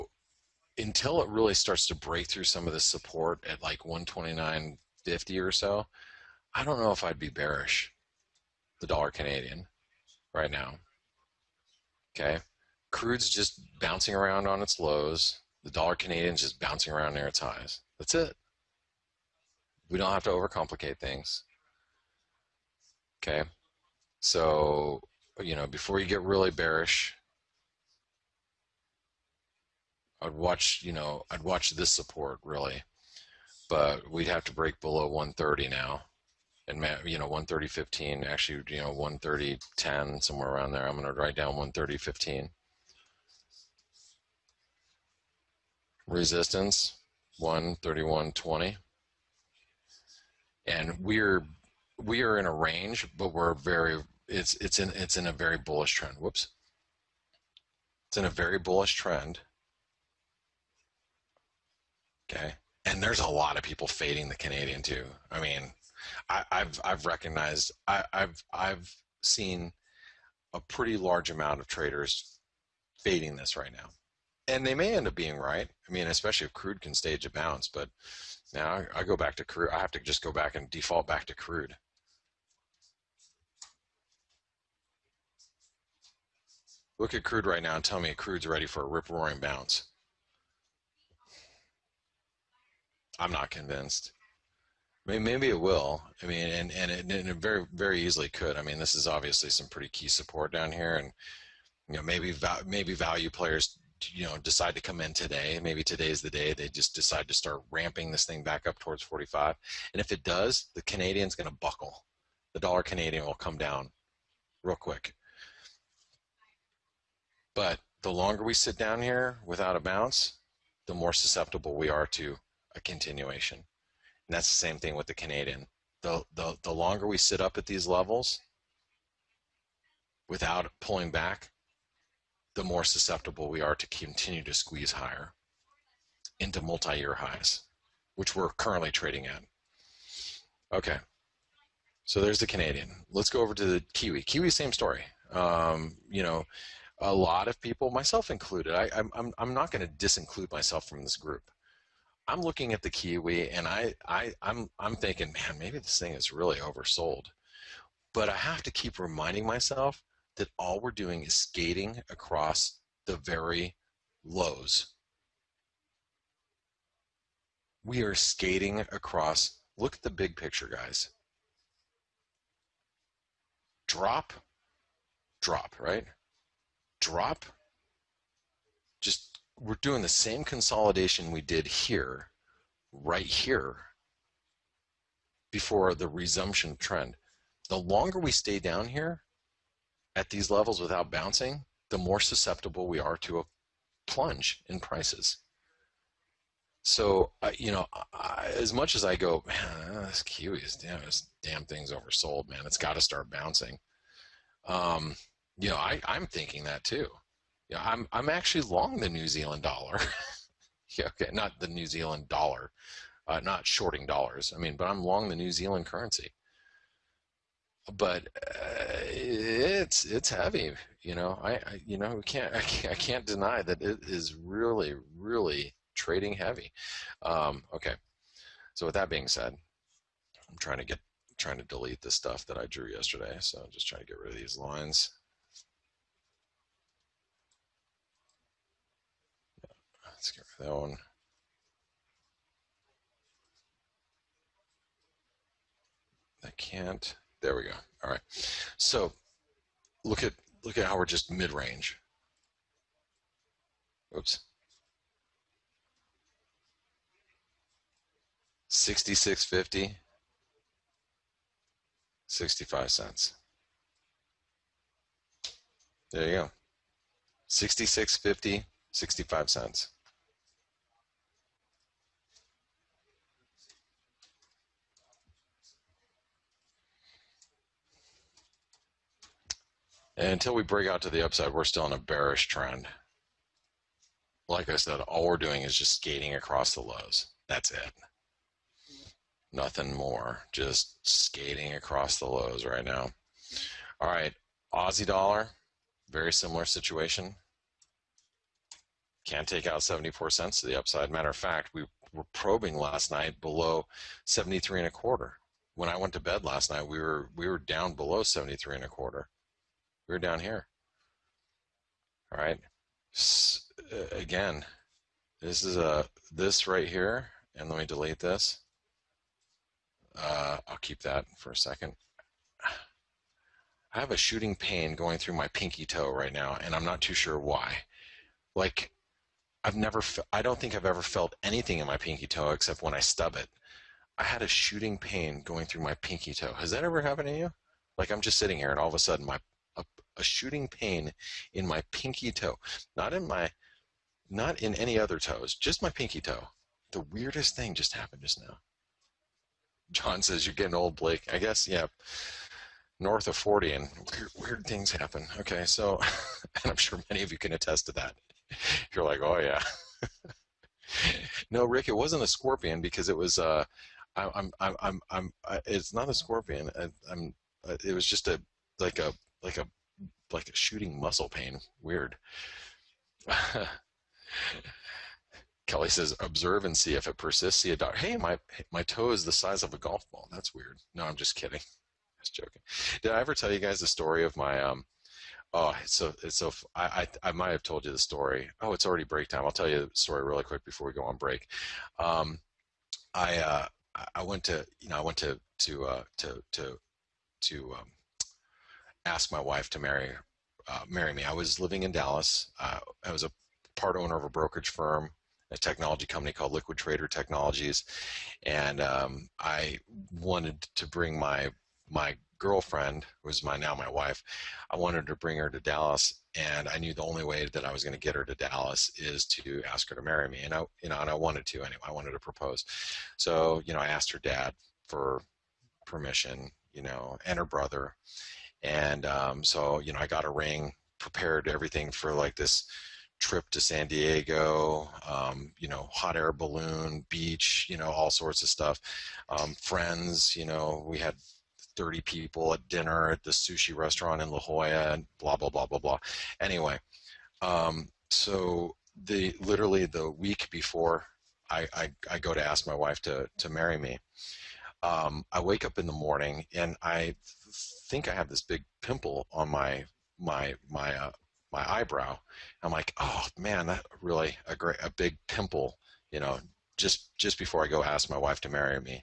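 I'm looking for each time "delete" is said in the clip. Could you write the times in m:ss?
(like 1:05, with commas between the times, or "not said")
3:51, 5:17.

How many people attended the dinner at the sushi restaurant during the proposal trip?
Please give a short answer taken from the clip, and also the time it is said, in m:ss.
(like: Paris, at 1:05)
30, at 7:21.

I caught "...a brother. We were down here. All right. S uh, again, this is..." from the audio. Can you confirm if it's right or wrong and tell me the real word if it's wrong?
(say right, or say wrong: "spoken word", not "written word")
wrong: "quarter", not "brother".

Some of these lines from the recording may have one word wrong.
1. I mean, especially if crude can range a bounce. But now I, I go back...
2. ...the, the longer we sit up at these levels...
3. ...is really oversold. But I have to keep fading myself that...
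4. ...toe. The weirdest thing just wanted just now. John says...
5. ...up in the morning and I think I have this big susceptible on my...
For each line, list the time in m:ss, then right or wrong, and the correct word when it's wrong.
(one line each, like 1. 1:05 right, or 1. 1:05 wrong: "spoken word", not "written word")
1. 1:15 wrong: "stage", not "range"
2. 2:06 right
3. 2:36 wrong: "reminding", not "fading"
4. 5:46 wrong: "happened", not "wanted"
5. 7:35 wrong: "pimple", not "susceptible".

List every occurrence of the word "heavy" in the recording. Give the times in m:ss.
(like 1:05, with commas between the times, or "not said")
3:40, 3:46.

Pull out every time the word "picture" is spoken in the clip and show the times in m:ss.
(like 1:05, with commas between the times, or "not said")
2:50.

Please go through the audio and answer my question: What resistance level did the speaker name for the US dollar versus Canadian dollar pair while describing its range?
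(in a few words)
131.20.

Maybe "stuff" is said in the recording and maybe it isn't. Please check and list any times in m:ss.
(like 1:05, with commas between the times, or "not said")
3:52, 7:18.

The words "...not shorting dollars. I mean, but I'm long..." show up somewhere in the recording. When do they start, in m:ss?
3:33.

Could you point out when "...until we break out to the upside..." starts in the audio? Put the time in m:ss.
4:40.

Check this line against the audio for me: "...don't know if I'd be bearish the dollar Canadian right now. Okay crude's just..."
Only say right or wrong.
right.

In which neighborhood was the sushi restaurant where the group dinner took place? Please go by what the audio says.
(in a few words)
La Jolla.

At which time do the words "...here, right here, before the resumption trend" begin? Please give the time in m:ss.
3:01.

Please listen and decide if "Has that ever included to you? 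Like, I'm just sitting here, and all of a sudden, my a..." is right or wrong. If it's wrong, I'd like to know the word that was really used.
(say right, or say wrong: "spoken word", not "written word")
wrong: "happened", not "included".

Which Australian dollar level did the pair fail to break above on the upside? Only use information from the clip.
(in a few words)
74 cents.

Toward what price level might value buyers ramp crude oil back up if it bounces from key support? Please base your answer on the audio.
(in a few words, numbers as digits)
45.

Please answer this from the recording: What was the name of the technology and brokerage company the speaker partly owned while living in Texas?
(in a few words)
Liquid Trader Technologies.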